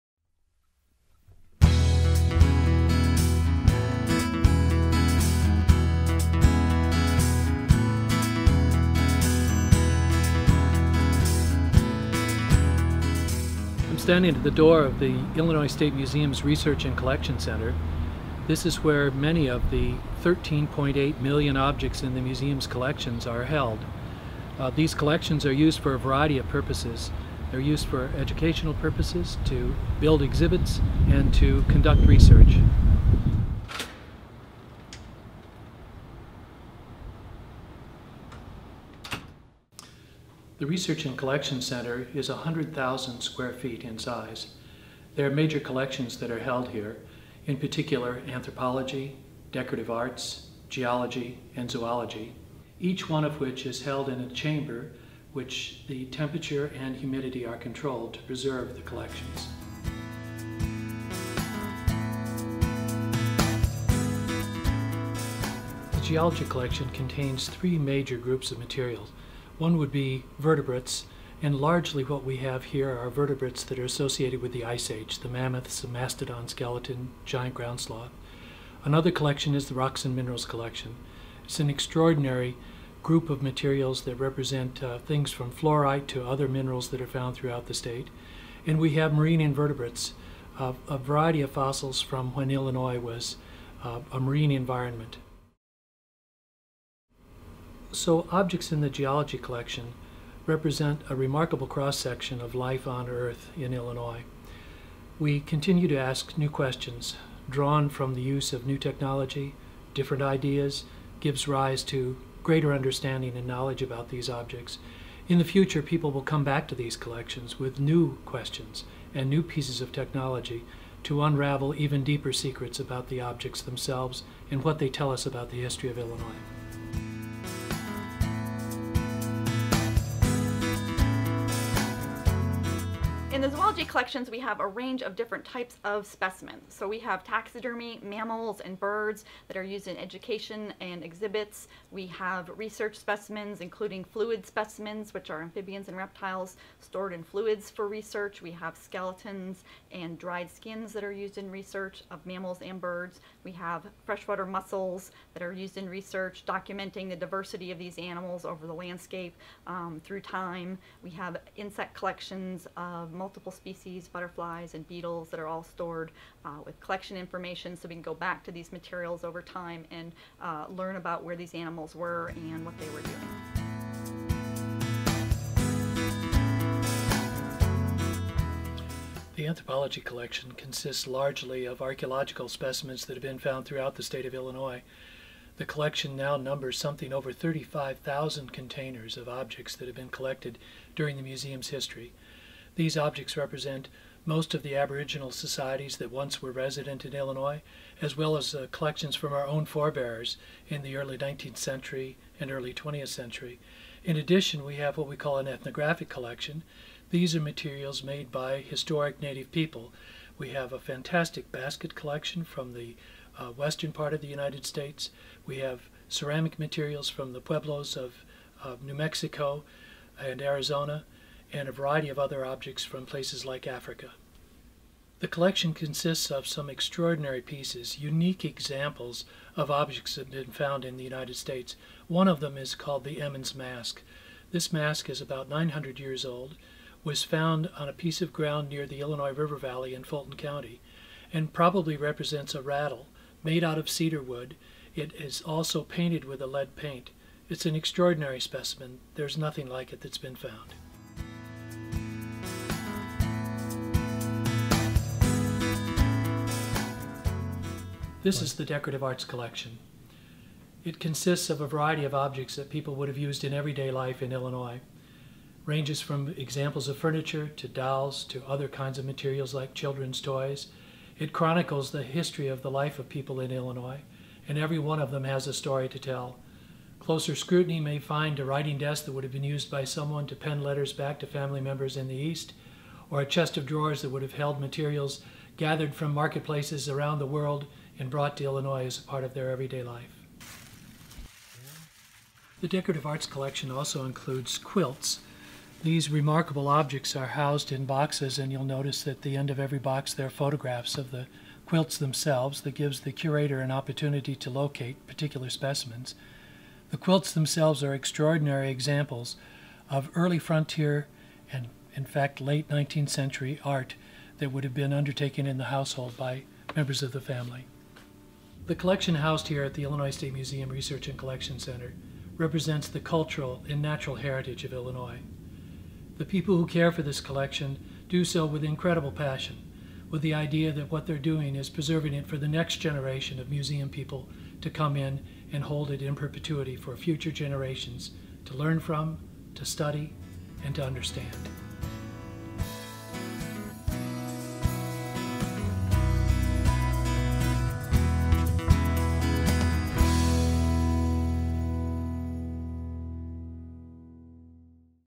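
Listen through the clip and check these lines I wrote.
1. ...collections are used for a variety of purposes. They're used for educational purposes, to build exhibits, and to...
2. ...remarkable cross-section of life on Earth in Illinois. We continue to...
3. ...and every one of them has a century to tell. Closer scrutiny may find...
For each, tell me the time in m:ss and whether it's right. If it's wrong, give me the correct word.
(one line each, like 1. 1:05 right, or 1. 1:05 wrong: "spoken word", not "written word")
1. 0:24 right
2. 1:41 right
3. 4:34 wrong: "story", not "century".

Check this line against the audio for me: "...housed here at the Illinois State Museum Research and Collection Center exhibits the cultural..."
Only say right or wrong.
wrong.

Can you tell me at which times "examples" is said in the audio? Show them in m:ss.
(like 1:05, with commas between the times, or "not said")
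3:48, 4:26, 5:08.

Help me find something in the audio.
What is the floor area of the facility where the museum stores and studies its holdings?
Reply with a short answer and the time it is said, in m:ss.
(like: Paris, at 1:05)
100,000 square feet, at 0:42.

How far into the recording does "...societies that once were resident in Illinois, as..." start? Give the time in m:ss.
3:15.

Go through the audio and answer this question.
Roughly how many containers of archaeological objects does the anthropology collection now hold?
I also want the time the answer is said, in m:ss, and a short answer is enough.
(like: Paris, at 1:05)
35,000, at 3:07.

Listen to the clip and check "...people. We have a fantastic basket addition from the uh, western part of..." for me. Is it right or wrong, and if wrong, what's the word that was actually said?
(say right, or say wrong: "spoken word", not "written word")
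wrong: "collection", not "addition".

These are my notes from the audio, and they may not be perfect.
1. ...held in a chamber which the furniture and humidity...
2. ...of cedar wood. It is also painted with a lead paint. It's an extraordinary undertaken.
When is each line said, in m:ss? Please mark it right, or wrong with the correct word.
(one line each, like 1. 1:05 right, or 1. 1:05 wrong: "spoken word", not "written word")
1. 0:53 wrong: "temperature", not "furniture"
2. 4:03 wrong: "specimen", not "undertaken".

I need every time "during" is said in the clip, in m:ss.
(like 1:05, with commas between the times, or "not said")
3:10.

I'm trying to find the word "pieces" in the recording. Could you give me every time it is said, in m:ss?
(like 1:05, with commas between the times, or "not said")
1:59, 3:47, 3:57.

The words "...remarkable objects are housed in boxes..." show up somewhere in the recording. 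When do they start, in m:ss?
4:56.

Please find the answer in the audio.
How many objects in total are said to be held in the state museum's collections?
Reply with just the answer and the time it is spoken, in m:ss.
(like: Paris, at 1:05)
13.8 million, at 0:20.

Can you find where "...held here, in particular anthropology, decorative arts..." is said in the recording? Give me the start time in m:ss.
0:46.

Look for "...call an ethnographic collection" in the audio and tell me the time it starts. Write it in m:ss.
3:25.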